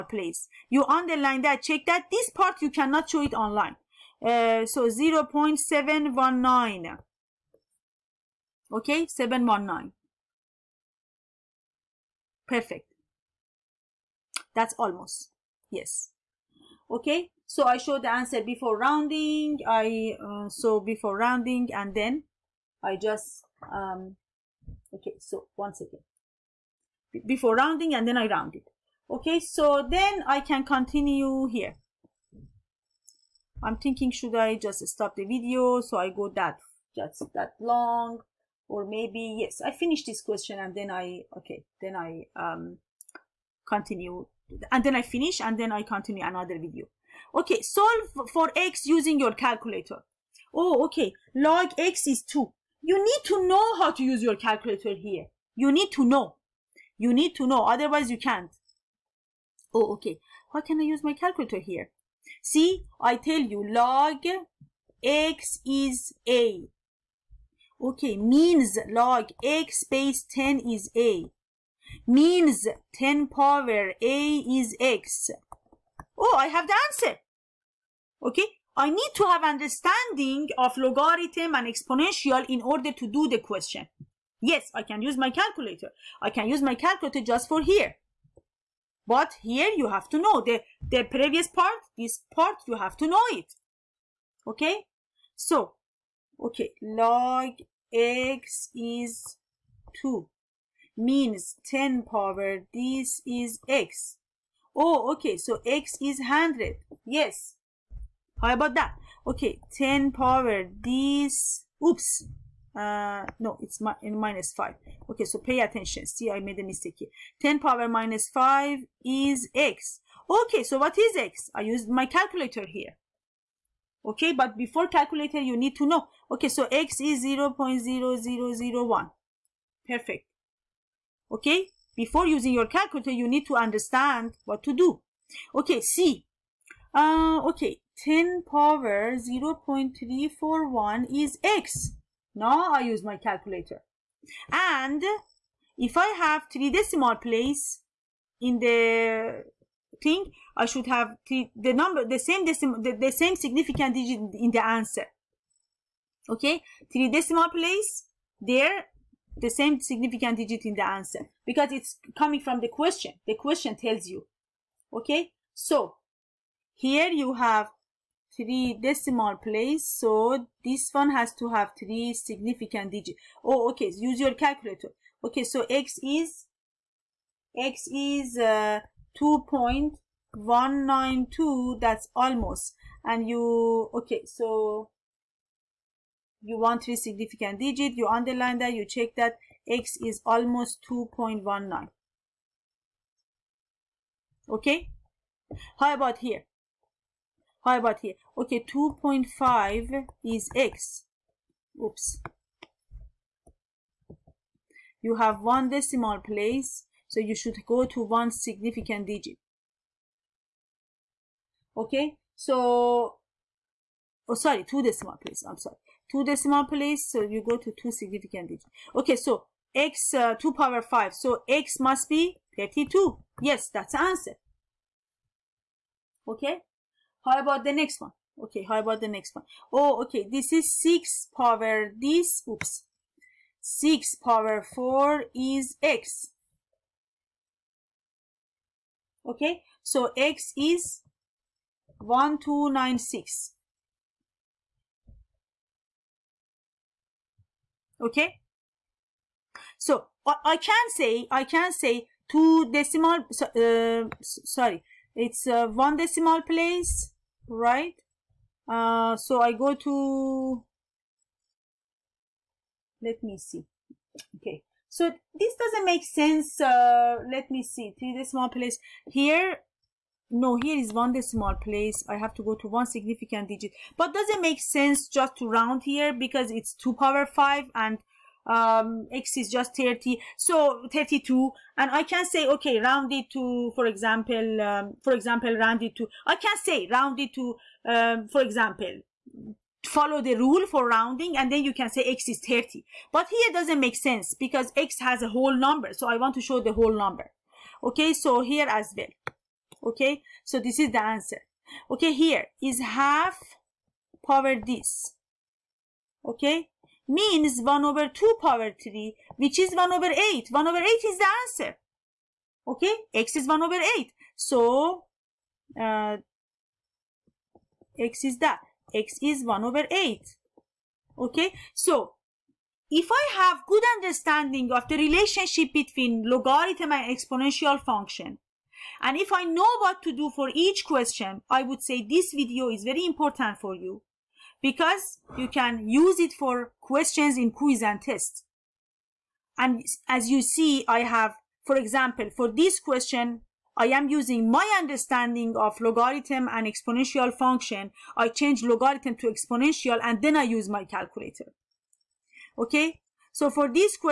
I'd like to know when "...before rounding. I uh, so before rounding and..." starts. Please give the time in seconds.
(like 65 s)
18 s.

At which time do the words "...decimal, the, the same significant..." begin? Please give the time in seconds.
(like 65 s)
152 s.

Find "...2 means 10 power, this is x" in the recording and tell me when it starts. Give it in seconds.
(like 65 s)
100 s.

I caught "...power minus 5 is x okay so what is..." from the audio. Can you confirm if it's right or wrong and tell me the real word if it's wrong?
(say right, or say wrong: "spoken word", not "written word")
right.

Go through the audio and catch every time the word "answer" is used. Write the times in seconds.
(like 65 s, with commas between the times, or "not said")
18 s, 76 s, 154 s, 160 s, 224 s, 301 s, 311 s.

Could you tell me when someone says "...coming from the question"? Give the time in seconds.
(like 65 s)
162 s.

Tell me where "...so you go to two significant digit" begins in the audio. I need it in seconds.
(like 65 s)
217 s.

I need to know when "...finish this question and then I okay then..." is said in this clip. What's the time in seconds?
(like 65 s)
39 s.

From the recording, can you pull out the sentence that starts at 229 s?
Oh, okay, this is 6 power this, oops, 6 power 4 is x.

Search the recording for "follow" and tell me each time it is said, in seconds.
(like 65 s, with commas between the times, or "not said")
289 s.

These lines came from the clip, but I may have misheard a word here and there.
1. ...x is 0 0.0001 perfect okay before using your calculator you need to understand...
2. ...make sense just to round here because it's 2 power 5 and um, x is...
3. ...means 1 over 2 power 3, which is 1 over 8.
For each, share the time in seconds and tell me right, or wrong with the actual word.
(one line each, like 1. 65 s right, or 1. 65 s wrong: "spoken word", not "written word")
1. 126 s right
2. 274 s right
3. 307 s right.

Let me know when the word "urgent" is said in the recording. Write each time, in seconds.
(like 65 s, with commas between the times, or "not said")
not said.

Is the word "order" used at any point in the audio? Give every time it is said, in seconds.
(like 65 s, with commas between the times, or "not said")
82 s.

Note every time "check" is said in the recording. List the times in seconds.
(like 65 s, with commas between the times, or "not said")
1 s, 188 s.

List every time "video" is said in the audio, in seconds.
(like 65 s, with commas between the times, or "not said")
35 s, 46 s, 332 s.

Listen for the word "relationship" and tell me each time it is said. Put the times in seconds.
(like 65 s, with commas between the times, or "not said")
324 s.